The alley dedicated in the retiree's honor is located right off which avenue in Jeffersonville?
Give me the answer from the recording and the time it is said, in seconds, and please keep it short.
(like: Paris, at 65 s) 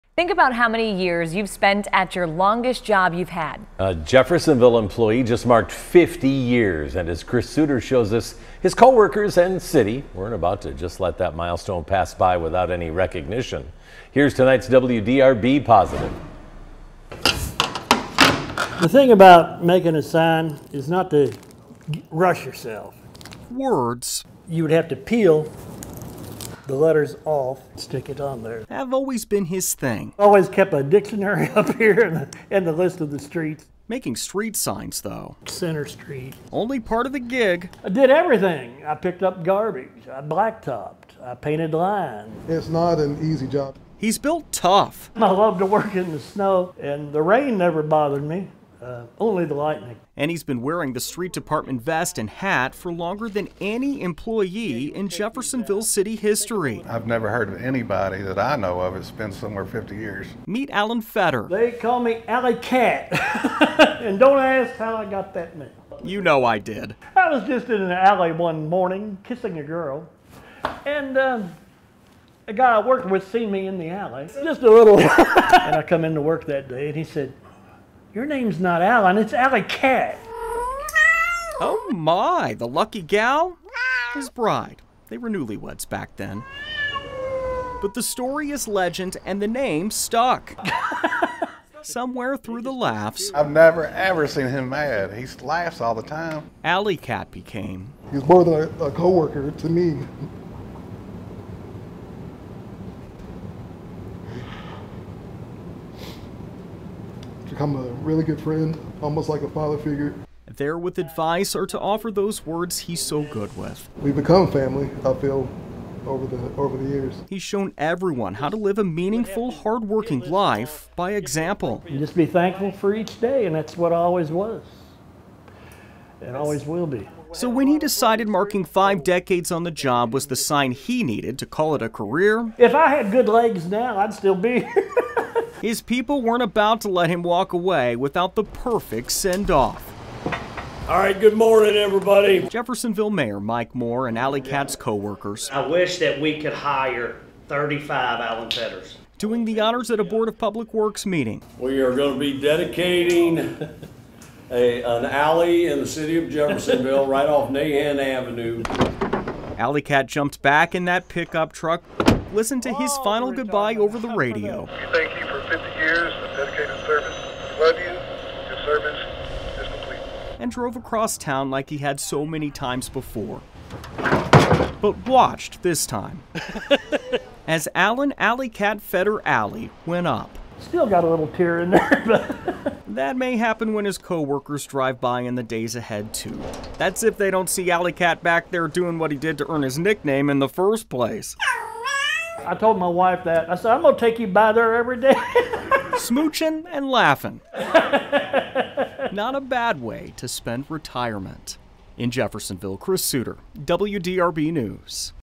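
Nahan Avenue, at 157 s.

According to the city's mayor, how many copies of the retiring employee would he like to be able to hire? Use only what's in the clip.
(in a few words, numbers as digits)
35.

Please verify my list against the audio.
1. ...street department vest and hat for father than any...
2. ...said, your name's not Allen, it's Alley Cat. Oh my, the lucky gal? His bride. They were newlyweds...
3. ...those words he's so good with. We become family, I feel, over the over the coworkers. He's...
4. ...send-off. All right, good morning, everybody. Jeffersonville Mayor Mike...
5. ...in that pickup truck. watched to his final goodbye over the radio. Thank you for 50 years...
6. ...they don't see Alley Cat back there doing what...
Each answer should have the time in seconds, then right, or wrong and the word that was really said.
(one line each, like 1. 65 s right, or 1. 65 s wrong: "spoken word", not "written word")
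1. 50 s wrong: "longer", not "father"
2. 77 s right
3. 112 s wrong: "years", not "coworkers"
4. 139 s right
5. 160 s wrong: "listened", not "watched"
6. 187 s right.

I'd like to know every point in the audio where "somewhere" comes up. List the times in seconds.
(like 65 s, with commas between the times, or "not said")
59 s, 91 s.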